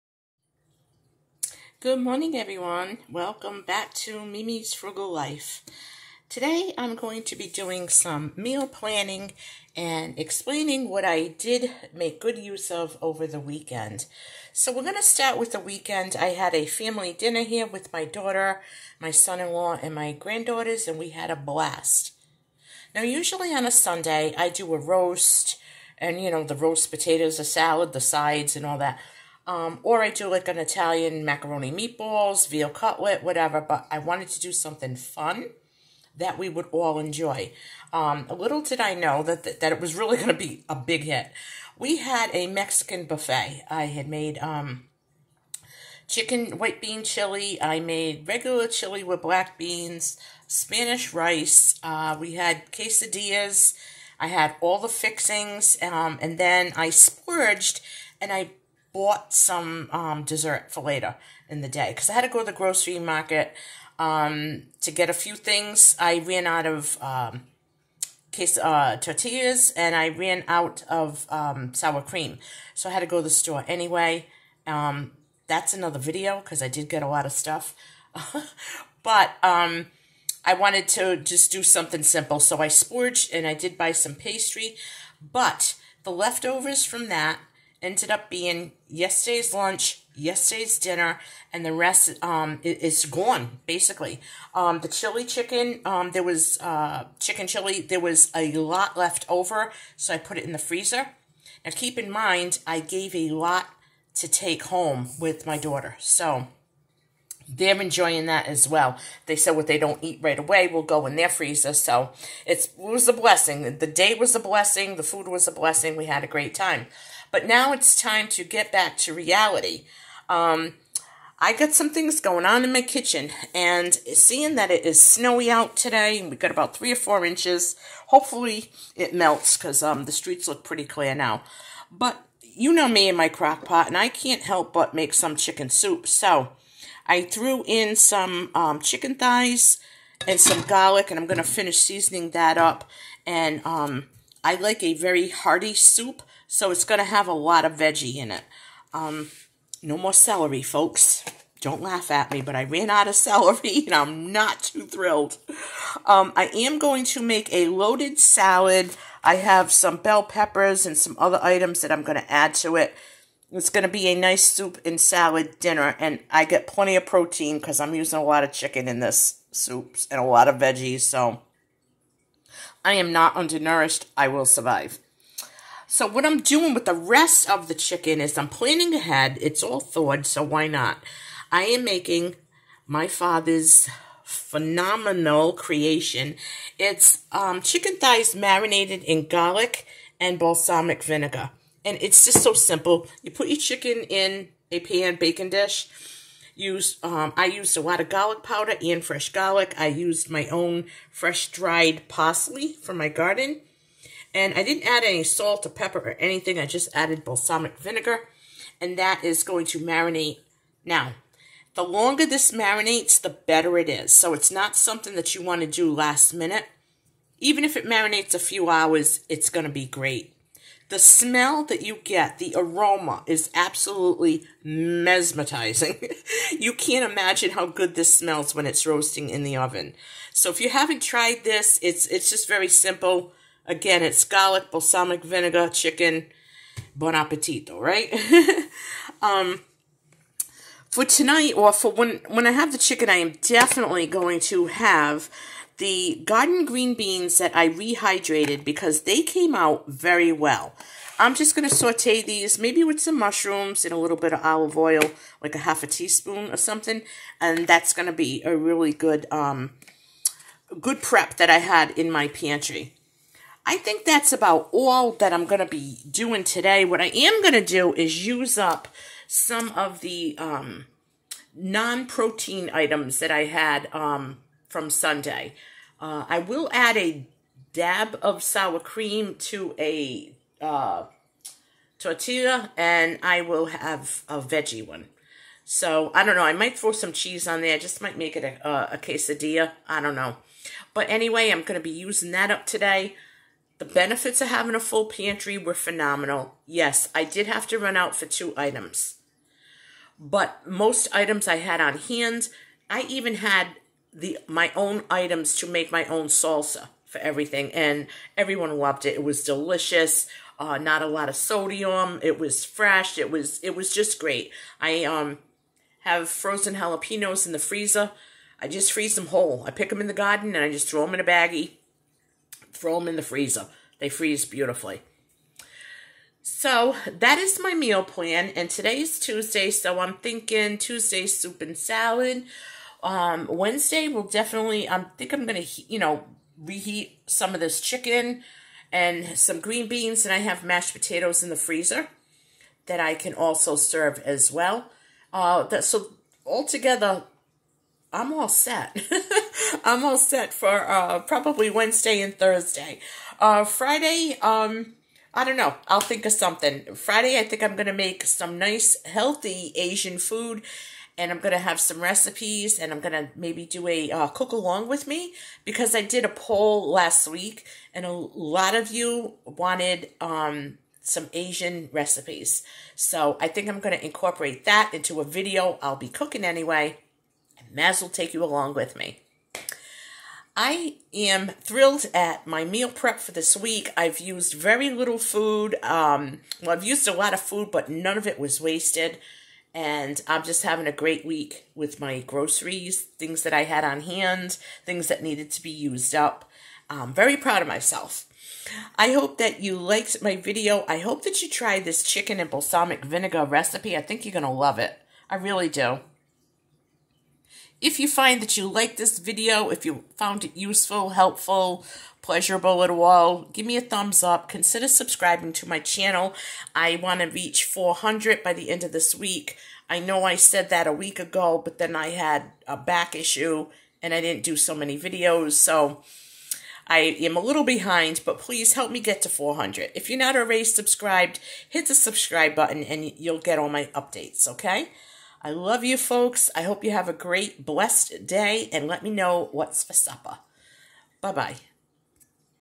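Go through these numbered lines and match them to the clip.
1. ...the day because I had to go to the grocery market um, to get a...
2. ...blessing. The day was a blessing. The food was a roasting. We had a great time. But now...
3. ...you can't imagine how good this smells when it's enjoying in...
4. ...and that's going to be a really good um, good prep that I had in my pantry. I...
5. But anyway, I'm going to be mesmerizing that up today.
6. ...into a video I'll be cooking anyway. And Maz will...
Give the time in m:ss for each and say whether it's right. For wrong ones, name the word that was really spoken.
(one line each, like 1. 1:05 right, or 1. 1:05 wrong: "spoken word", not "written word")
1. 1:01 right
2. 1:53 wrong: "blessing", not "roasting"
3. 3:46 wrong: "roasting", not "enjoying"
4. 4:17 right
5. 4:50 wrong: "using", not "mesmerizing"
6. 6:14 right.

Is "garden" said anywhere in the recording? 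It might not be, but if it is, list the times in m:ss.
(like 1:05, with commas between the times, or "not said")
3:23, 4:06, 5:20.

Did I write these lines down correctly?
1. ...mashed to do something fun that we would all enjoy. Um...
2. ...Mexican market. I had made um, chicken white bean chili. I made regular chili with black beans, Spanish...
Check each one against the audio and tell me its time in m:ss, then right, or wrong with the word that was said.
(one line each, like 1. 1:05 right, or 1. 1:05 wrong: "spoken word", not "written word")
1. 0:33 wrong: "wanted", not "mashed"
2. 0:42 wrong: "buffet", not "market".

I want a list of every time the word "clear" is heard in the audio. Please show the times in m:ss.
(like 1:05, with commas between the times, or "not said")
2:10.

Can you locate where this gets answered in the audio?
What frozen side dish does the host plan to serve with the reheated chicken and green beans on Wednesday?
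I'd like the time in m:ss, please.
5:40.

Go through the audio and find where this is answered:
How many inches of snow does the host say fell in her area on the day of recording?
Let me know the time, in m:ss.
2:06.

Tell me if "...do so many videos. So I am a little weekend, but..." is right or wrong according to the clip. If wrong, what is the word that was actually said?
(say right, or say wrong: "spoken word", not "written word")
wrong: "behind", not "weekend".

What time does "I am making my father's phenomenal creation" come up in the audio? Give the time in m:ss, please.
3:01.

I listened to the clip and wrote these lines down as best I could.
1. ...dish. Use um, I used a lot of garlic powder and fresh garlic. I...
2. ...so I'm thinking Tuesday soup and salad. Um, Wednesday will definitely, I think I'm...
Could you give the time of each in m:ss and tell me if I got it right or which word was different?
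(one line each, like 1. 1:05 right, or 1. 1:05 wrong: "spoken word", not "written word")
1. 3:15 right
2. 5:29 right.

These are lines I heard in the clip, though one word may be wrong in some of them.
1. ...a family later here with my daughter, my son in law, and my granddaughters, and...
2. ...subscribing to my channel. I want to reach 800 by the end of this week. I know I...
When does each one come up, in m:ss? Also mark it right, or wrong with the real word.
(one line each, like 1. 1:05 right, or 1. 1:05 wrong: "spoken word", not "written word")
1. 0:16 wrong: "dinner", not "later"
2. 6:54 wrong: "400", not "800".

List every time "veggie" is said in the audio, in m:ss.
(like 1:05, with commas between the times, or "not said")
2:27, 2:50, 4:44.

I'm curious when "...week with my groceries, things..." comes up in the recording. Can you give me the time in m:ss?
6:31.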